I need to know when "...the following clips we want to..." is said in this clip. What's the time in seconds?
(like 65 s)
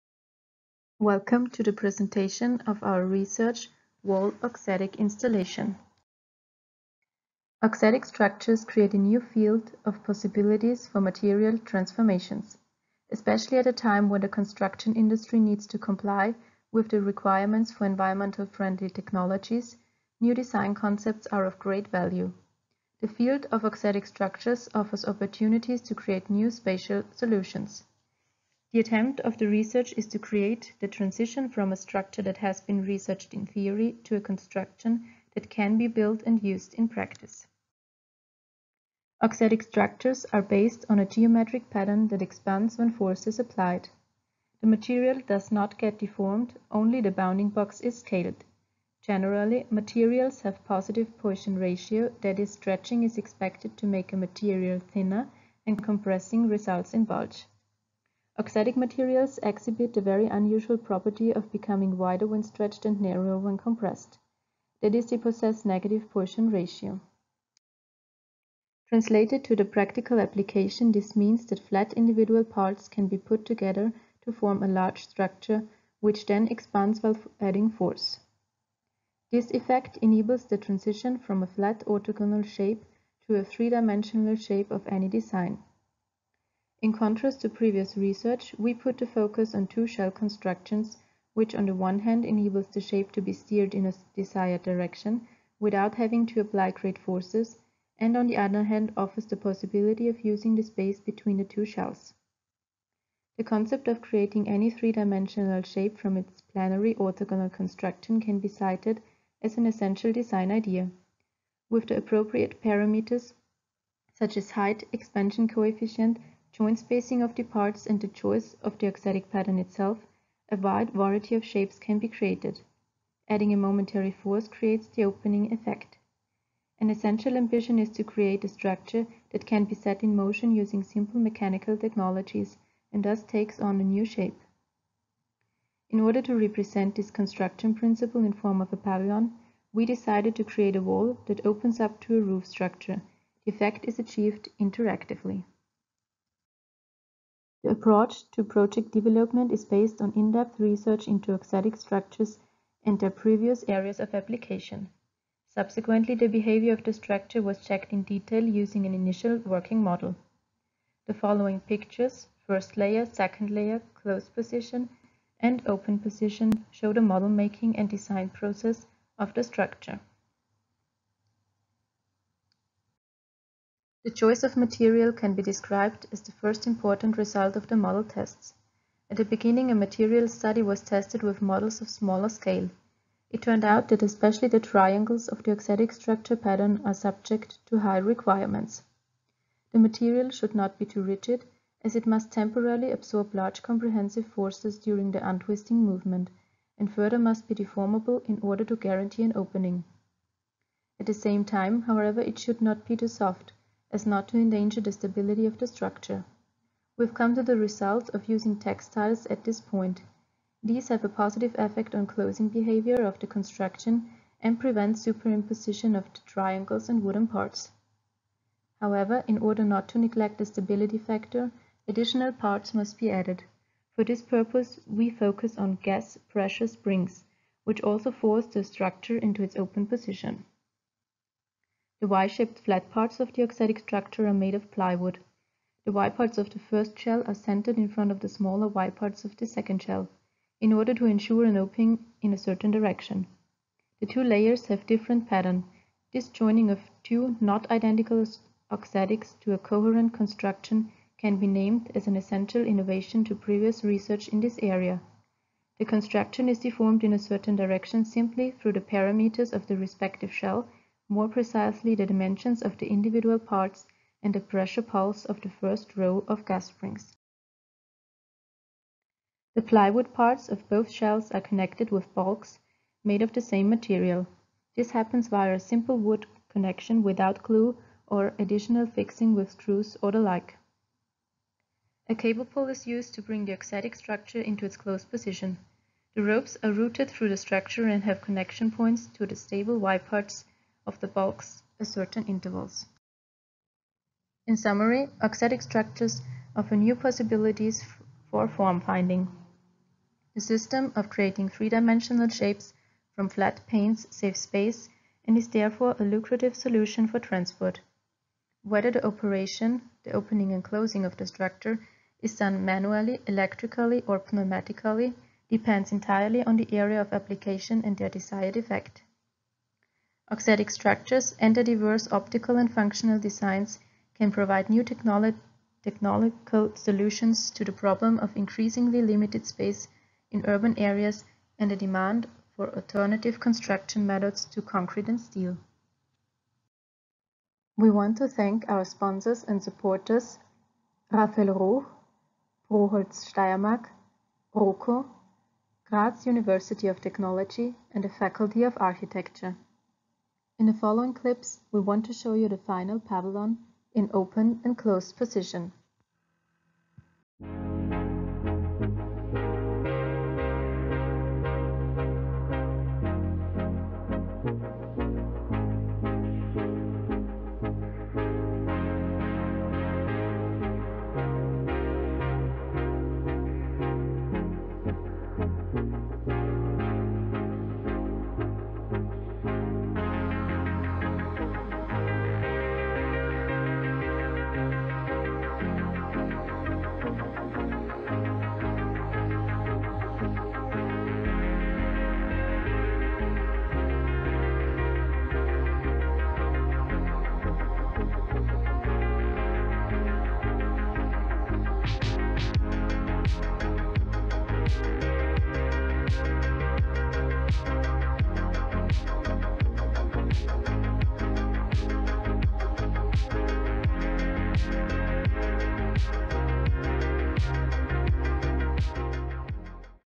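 350 s.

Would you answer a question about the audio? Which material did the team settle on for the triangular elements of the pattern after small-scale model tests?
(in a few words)
Textiles.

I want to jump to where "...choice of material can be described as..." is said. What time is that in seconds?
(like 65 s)
174 s.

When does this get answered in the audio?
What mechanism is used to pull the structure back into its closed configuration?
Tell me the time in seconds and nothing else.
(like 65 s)
282 s.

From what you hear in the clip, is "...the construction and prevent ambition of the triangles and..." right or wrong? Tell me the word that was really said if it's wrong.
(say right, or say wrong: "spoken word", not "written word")
wrong: "superimposition", not "ambition".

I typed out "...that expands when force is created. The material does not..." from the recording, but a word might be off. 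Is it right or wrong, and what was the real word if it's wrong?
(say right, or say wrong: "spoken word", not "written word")
wrong: "applied", not "created".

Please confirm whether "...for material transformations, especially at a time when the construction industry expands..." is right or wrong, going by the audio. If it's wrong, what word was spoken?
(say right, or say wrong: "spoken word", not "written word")
wrong: "needs", not "expands".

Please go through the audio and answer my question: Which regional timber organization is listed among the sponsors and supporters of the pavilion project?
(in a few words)
proHolz Steiermark.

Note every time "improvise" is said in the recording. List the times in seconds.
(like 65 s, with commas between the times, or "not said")
not said.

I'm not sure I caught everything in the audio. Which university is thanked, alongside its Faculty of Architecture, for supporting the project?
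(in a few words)
Graz University of Technology.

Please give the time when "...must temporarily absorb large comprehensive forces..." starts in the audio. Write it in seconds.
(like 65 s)
192 s.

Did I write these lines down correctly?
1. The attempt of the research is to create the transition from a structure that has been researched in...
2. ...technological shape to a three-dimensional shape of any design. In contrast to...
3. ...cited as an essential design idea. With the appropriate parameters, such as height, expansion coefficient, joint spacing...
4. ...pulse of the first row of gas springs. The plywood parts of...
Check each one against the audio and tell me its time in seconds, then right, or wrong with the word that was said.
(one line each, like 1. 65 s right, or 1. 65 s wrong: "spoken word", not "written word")
1. 28 s right
2. 81 s wrong: "orthogonal", not "technological"
3. 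108 s right
4. 264 s right.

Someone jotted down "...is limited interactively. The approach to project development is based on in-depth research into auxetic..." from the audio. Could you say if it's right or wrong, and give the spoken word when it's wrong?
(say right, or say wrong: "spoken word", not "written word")
wrong: "achieved", not "limited".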